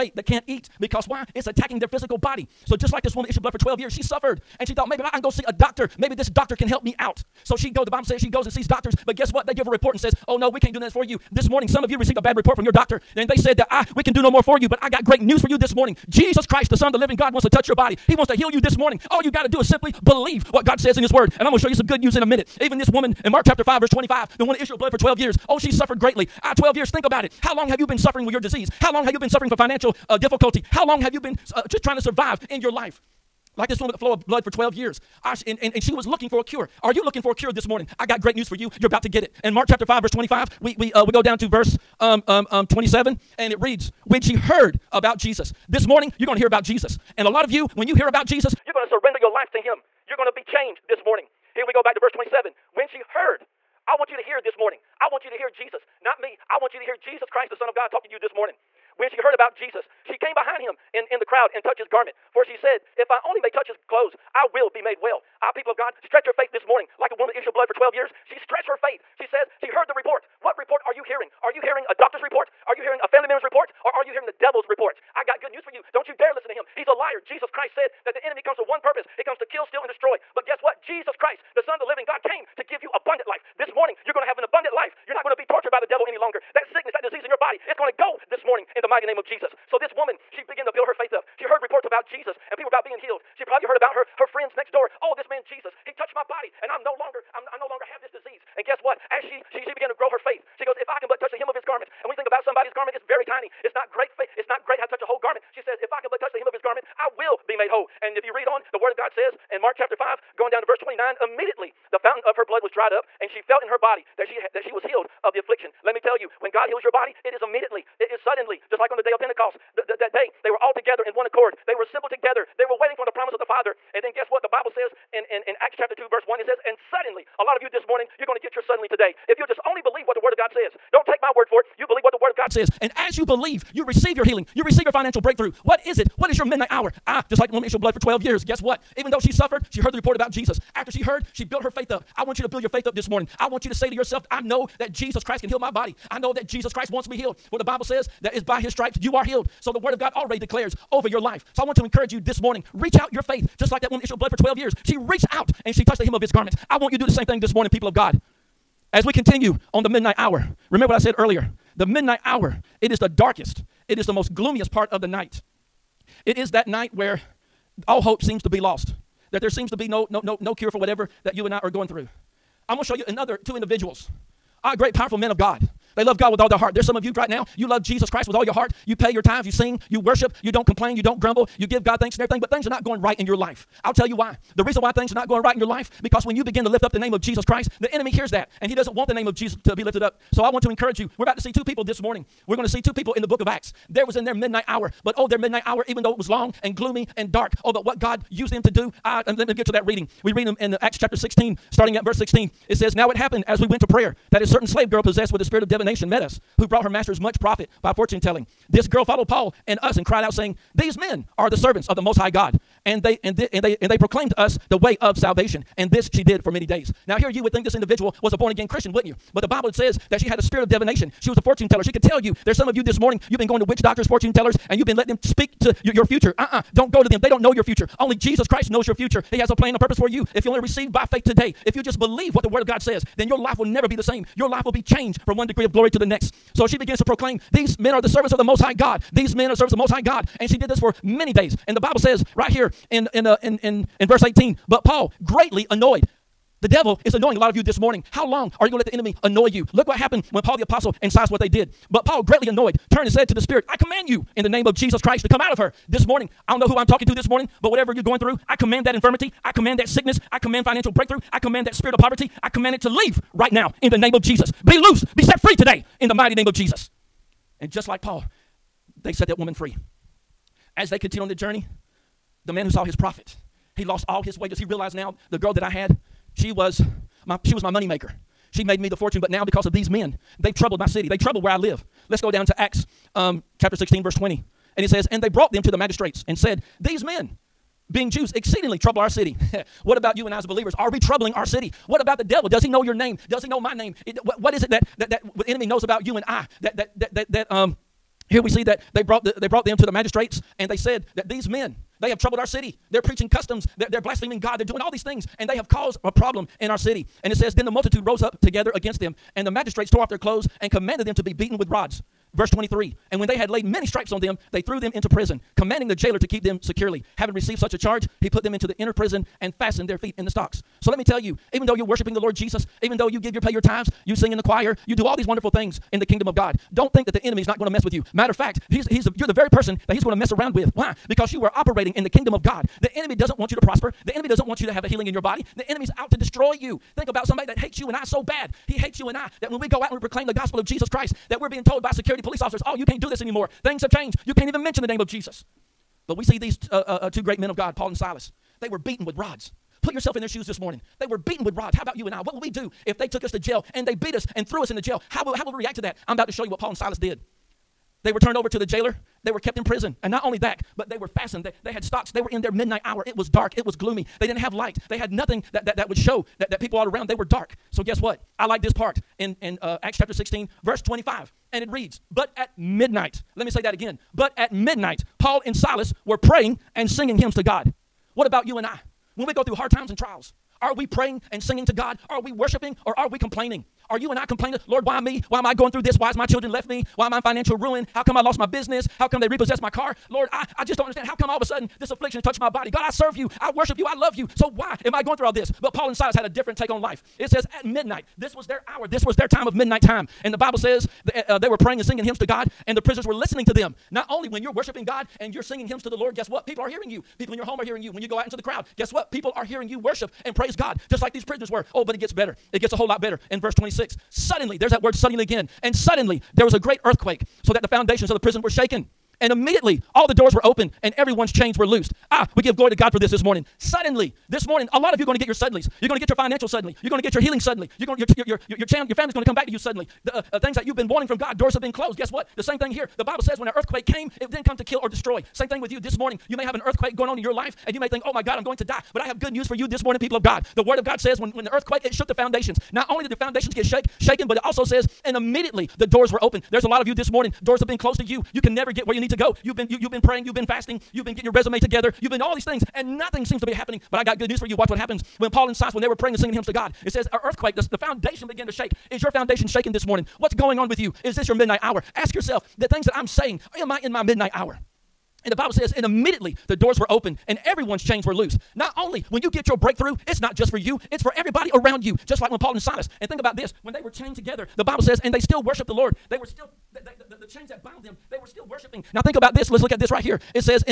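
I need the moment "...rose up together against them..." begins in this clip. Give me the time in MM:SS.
05:08.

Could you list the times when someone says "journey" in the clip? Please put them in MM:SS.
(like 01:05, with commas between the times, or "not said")
04:31.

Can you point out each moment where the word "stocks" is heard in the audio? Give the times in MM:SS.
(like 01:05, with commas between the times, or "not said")
05:20, 06:01.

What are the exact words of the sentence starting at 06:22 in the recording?
Are we worshiping or are we complaining?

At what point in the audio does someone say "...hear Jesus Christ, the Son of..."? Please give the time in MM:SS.
00:56.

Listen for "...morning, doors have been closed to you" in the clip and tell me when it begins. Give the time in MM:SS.
07:27.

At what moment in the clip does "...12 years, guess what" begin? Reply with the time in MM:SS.
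02:17.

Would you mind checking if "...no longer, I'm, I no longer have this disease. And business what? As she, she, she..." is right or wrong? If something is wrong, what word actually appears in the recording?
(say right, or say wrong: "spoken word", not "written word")
wrong: "guess", not "business".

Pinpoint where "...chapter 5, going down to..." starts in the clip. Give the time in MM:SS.
01:49.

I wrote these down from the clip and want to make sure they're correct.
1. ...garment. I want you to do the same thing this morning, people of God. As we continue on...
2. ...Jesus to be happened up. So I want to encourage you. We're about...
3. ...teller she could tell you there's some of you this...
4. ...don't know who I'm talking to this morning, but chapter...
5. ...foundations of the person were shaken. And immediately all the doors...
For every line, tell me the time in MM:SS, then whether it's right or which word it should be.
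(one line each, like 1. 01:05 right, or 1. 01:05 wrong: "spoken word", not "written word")
1. 02:36 right
2. 03:09 wrong: "lifted", not "happened"
3. 03:41 right
4. 04:16 wrong: "whatever", not "chapter"
5. 06:57 wrong: "prison", not "person".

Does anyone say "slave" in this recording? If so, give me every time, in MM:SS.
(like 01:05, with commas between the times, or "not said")
03:24.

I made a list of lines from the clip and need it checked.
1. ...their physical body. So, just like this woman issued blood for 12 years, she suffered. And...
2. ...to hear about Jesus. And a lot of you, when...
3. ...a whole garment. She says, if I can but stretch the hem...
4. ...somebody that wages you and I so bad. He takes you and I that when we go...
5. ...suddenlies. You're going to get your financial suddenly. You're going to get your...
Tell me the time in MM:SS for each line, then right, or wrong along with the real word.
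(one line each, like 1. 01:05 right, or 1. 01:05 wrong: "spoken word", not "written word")
1. 00:01 right
2. 00:46 right
3. 01:45 wrong: "touch", not "stretch"
4. 05:37 wrong: "hates", not "wages"
5. 07:05 right.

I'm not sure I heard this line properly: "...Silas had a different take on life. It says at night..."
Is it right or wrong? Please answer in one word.
wrong.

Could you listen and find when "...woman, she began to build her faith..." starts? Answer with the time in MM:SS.
01:29.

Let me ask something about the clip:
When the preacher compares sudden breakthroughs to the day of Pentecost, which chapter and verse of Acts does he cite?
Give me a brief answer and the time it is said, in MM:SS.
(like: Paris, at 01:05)
Acts 2:1, at 02:05.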